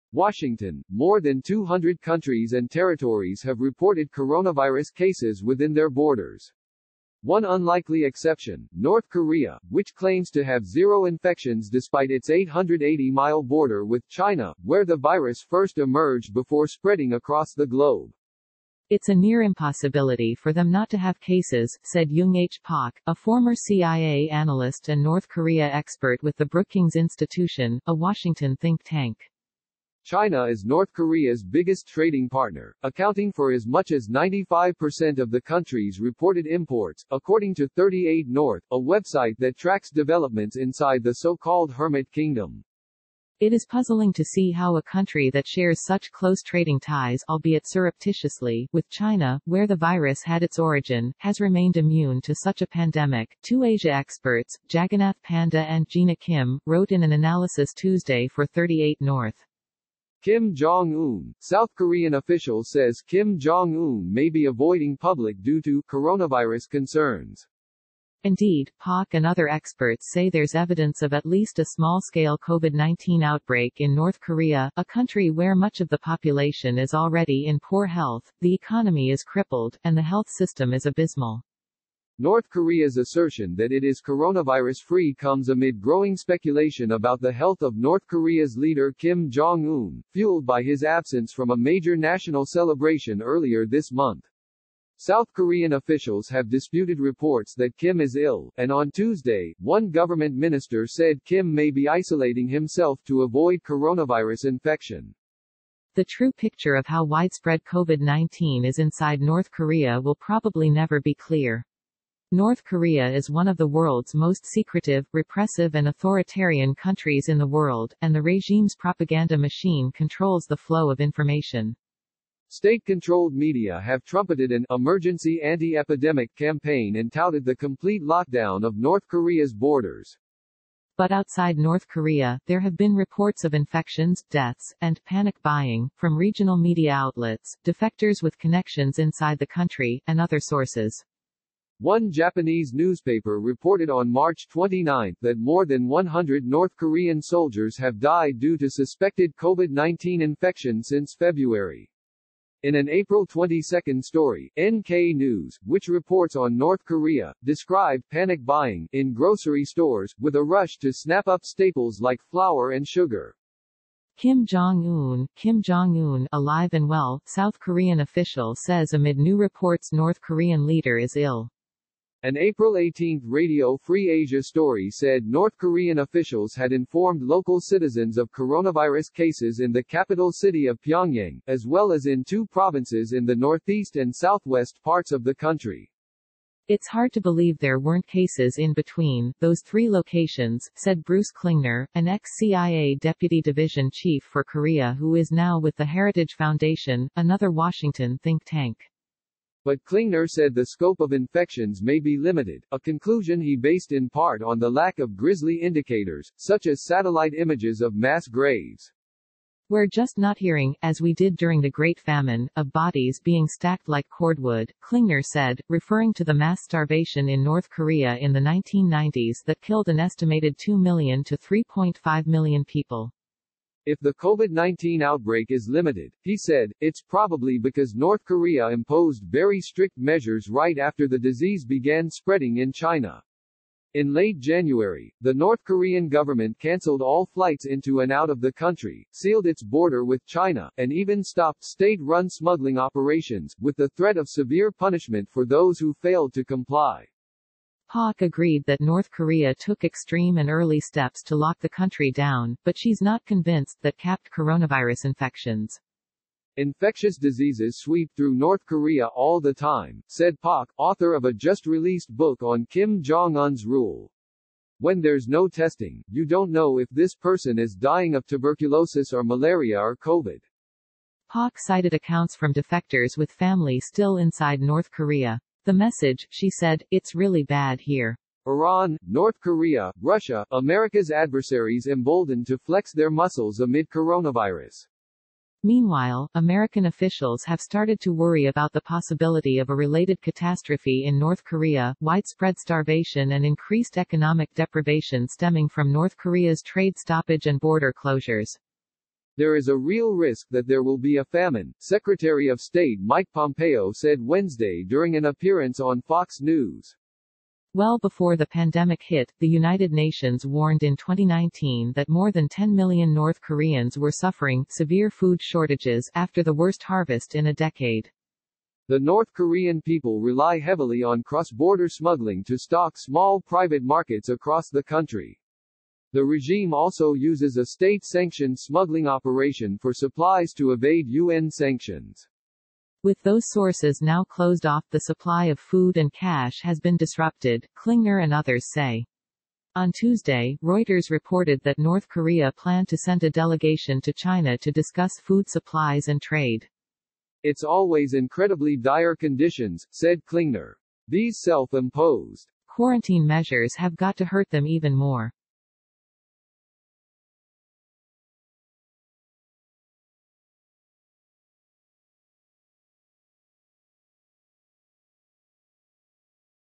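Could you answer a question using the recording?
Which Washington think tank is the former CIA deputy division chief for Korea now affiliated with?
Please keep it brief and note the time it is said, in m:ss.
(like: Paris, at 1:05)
Heritage Foundation, at 3:15.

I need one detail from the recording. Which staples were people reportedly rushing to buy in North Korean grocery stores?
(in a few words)
flour and sugar.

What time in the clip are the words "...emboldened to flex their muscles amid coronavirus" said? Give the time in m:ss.
4:41.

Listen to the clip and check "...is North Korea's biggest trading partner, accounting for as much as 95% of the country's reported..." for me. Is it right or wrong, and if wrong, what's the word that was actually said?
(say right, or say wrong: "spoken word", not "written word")
right.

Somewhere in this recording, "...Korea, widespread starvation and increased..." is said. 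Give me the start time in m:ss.
4:51.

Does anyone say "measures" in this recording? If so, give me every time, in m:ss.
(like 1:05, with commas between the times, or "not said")
3:49, 5:53.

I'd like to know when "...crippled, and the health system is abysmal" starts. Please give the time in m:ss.
1:19.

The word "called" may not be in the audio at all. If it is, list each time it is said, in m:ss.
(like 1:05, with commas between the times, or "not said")
0:41.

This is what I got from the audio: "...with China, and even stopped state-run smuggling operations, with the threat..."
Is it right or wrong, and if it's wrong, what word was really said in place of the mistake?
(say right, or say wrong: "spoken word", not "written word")
right.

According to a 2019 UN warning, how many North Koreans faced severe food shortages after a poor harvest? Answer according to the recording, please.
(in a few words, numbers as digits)
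more than 10 million.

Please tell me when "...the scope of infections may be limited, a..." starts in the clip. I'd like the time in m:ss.
3:20.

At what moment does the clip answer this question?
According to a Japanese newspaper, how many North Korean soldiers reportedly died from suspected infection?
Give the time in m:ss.
2:25.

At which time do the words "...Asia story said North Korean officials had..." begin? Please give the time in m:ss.
2:54.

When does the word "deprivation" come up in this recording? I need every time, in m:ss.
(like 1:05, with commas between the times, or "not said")
4:54.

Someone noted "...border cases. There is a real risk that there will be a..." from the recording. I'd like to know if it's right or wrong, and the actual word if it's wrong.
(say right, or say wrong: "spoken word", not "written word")
wrong: "closures", not "cases".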